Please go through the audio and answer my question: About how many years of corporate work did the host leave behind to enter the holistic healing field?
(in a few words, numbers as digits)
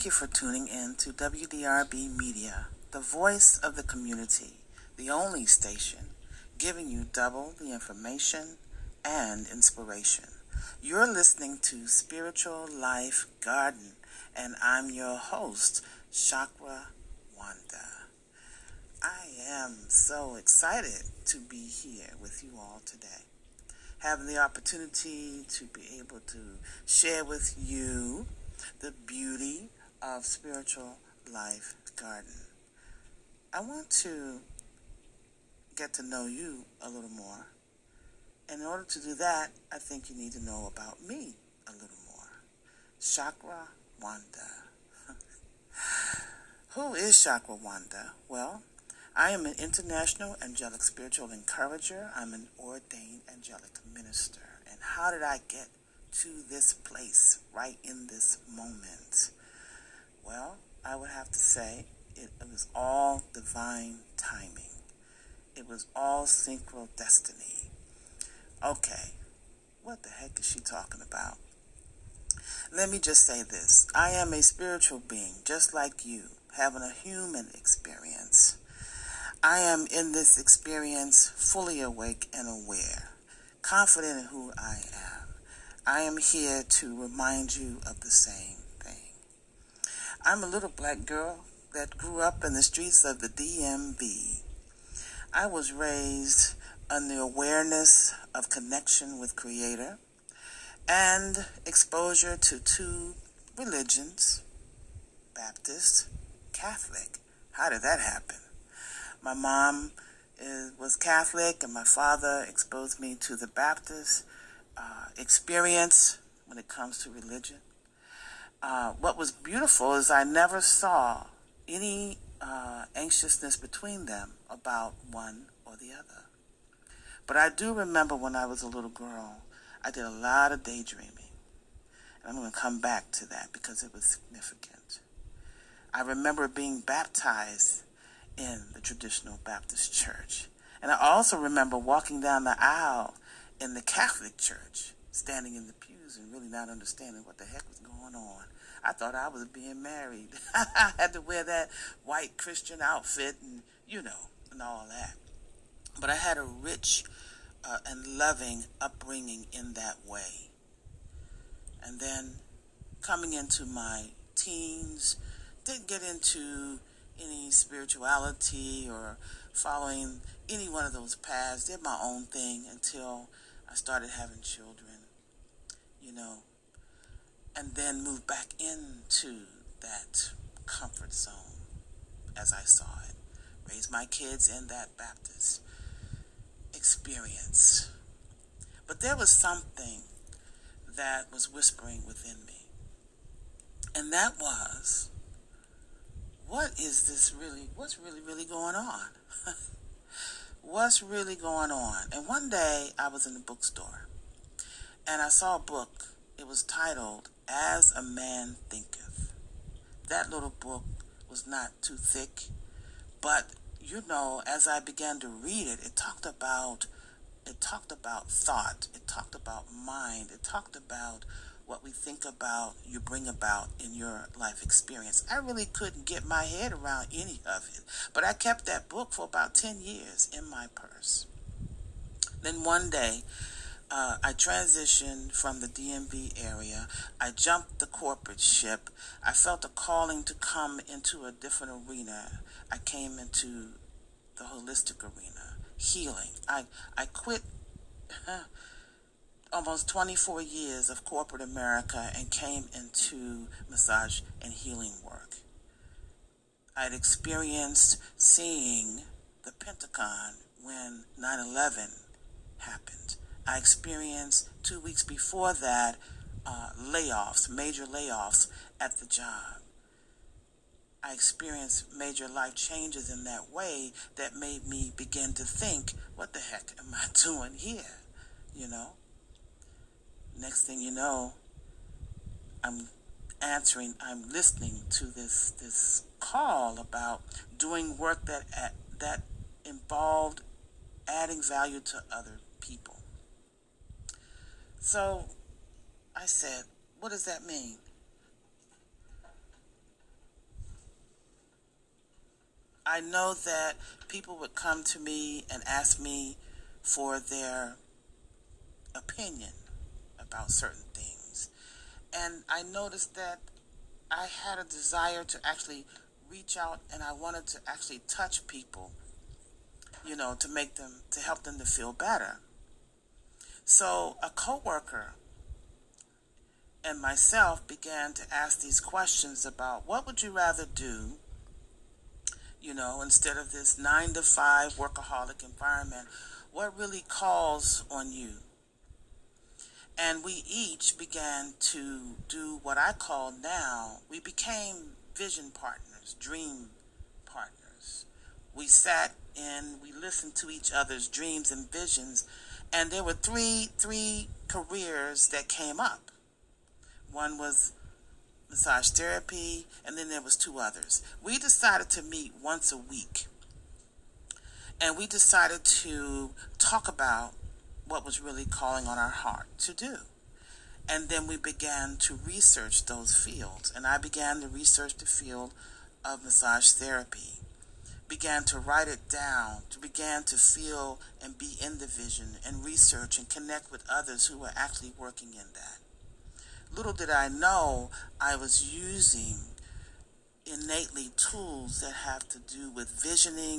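24 years.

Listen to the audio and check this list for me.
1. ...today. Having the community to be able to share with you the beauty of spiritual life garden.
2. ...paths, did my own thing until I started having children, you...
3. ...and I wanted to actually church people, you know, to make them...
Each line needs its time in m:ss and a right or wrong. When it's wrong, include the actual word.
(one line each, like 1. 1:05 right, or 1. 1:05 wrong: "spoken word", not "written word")
1. 0:22 wrong: "opportunity", not "community"
2. 2:51 right
3. 5:16 wrong: "touch", not "church".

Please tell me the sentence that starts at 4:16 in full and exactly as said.
I had experienced seeing the Pentagon when 9 11 happened.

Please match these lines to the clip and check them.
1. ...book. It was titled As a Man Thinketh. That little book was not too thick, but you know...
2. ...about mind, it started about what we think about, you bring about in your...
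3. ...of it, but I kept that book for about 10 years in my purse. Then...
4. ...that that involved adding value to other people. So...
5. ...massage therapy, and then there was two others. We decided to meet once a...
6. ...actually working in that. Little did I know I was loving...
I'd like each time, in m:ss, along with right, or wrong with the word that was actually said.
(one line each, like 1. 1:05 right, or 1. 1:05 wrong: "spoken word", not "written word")
1. 3:25 right
2. 3:39 wrong: "talked", not "started"
3. 3:47 right
4. 4:48 right
5. 5:58 right
6. 6:24 wrong: "using", not "loving".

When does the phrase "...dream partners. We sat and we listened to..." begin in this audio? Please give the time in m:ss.
5:46.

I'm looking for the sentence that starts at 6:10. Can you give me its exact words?
And then we began to research those fields.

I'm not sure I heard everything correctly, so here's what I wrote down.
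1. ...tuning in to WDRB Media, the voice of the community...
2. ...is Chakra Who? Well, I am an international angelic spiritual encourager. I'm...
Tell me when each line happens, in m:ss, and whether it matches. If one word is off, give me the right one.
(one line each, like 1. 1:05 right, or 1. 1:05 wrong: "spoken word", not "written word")
1. 0:00 right
2. 0:46 wrong: "Wanda", not "Who".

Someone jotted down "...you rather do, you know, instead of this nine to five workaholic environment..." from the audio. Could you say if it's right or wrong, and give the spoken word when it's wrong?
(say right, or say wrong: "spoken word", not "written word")
right.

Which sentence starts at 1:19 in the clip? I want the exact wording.
I am in this experience fully awake and aware, confident in who I am.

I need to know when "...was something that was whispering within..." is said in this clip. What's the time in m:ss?
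3:09.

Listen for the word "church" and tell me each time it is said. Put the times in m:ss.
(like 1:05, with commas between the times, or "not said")
2:19, 2:24.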